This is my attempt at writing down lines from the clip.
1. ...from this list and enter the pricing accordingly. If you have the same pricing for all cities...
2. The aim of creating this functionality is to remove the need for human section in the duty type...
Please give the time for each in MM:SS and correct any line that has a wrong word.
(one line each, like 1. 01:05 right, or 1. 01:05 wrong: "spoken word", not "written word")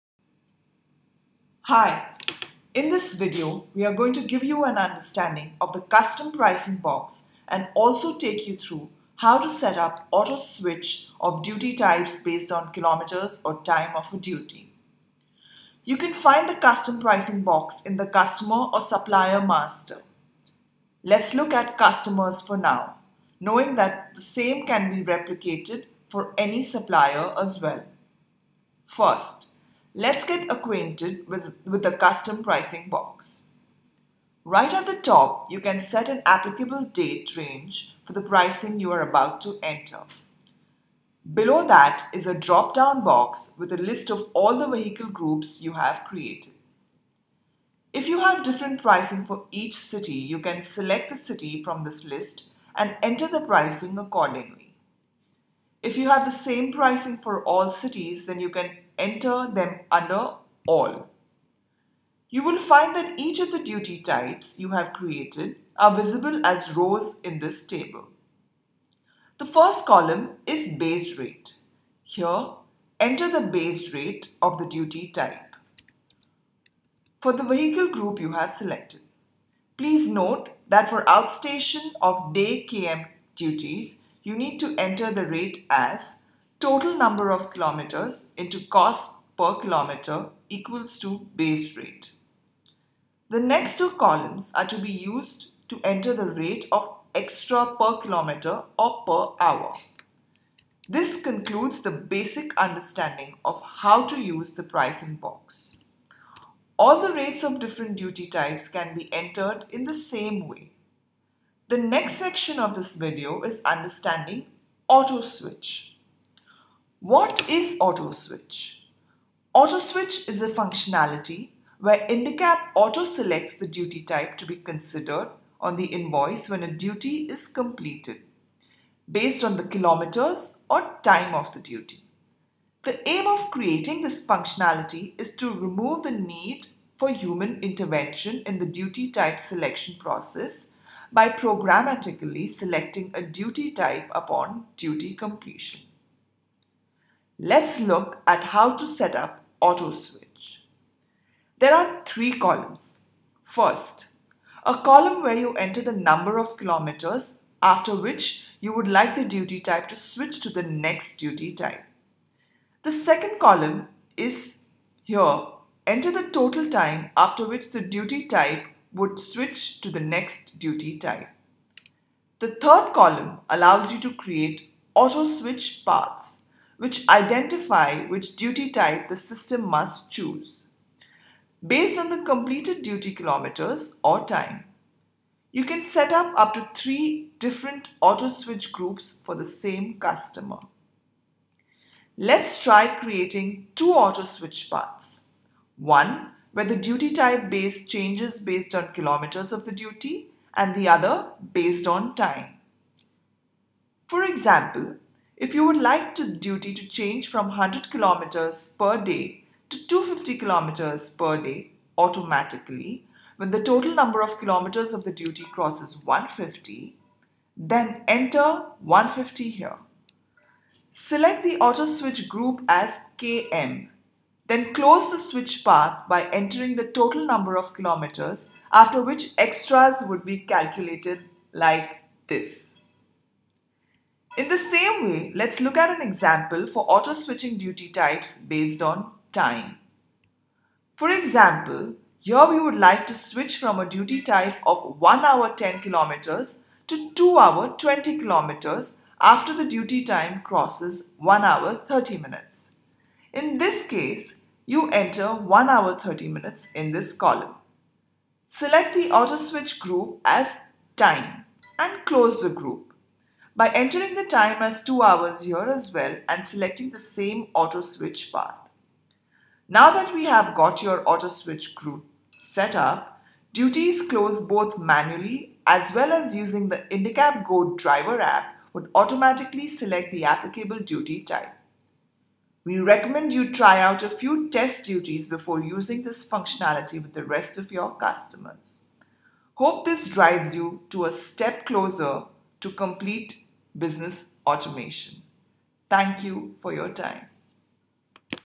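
1. 00:51 right
2. 02:12 wrong: "intervention", not "section".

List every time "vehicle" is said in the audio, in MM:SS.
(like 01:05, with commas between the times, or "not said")
00:44, 01:17.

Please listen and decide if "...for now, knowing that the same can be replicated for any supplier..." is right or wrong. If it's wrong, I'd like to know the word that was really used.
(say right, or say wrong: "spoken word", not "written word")
right.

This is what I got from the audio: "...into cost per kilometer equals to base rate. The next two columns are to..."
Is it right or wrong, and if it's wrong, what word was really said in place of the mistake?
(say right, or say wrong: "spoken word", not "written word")
right.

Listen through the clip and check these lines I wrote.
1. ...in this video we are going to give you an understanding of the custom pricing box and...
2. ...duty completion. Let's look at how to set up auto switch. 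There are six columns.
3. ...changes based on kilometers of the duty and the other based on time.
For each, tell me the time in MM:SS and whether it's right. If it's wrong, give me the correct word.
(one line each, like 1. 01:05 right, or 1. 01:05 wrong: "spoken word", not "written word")
1. 00:02 right
2. 02:24 wrong: "three", not "six"
3. 03:17 right.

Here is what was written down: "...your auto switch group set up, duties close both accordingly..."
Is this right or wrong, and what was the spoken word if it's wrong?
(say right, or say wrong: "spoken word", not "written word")
wrong: "manually", not "accordingly".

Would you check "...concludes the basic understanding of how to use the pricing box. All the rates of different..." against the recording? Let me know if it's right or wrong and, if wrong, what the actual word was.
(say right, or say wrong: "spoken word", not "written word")
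right.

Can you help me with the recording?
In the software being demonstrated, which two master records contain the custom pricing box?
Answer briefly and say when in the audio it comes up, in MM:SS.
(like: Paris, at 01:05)
Customer or supplier master, at 00:18.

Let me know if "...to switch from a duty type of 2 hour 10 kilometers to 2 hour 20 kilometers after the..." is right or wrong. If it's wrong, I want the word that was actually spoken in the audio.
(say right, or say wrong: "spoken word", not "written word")
wrong: "1", not "2".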